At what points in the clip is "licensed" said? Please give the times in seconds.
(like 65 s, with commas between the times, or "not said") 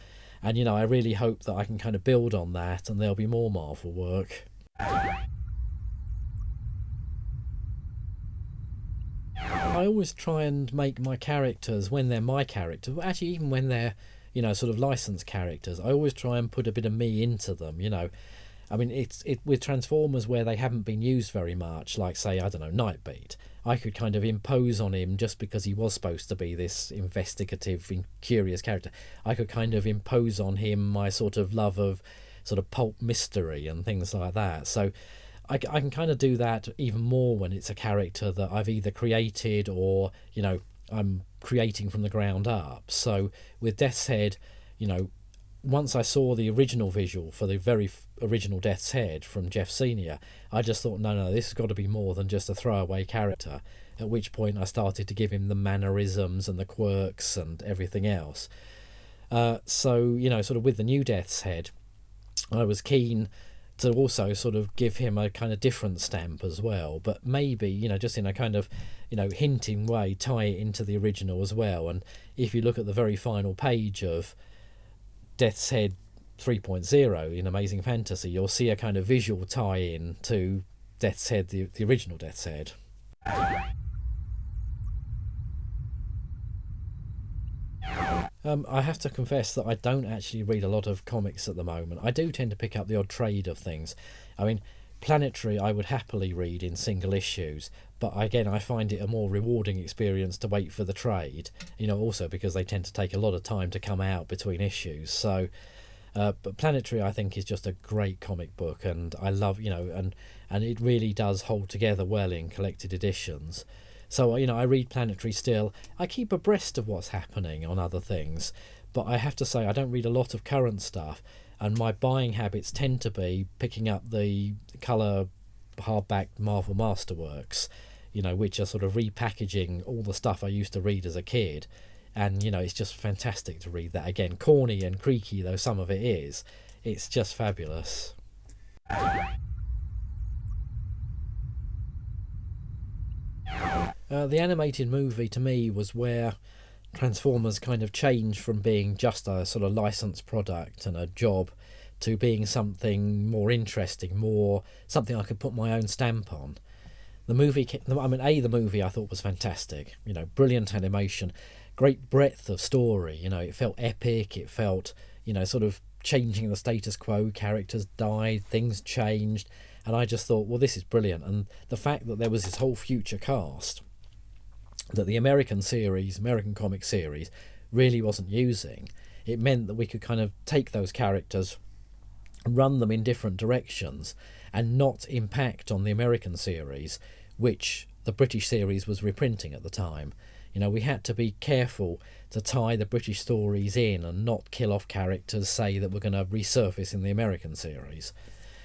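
14 s, 149 s.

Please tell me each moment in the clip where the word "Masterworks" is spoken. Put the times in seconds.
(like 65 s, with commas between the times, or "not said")
126 s.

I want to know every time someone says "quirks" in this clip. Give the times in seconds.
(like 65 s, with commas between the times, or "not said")
56 s.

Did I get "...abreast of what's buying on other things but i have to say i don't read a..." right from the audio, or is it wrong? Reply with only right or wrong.
wrong.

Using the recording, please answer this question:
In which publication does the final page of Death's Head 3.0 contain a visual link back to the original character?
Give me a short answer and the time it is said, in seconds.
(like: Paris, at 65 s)
Amazing Fantasy, at 77 s.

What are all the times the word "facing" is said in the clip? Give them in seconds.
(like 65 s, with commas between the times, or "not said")
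not said.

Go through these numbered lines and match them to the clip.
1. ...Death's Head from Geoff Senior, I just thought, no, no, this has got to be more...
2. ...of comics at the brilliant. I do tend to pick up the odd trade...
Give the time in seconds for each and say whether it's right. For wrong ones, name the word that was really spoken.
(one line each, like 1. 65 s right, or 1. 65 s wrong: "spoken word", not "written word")
1. 48 s right
2. 90 s wrong: "moment", not "brilliant".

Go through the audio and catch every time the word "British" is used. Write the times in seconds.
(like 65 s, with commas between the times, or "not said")
188 s, 192 s.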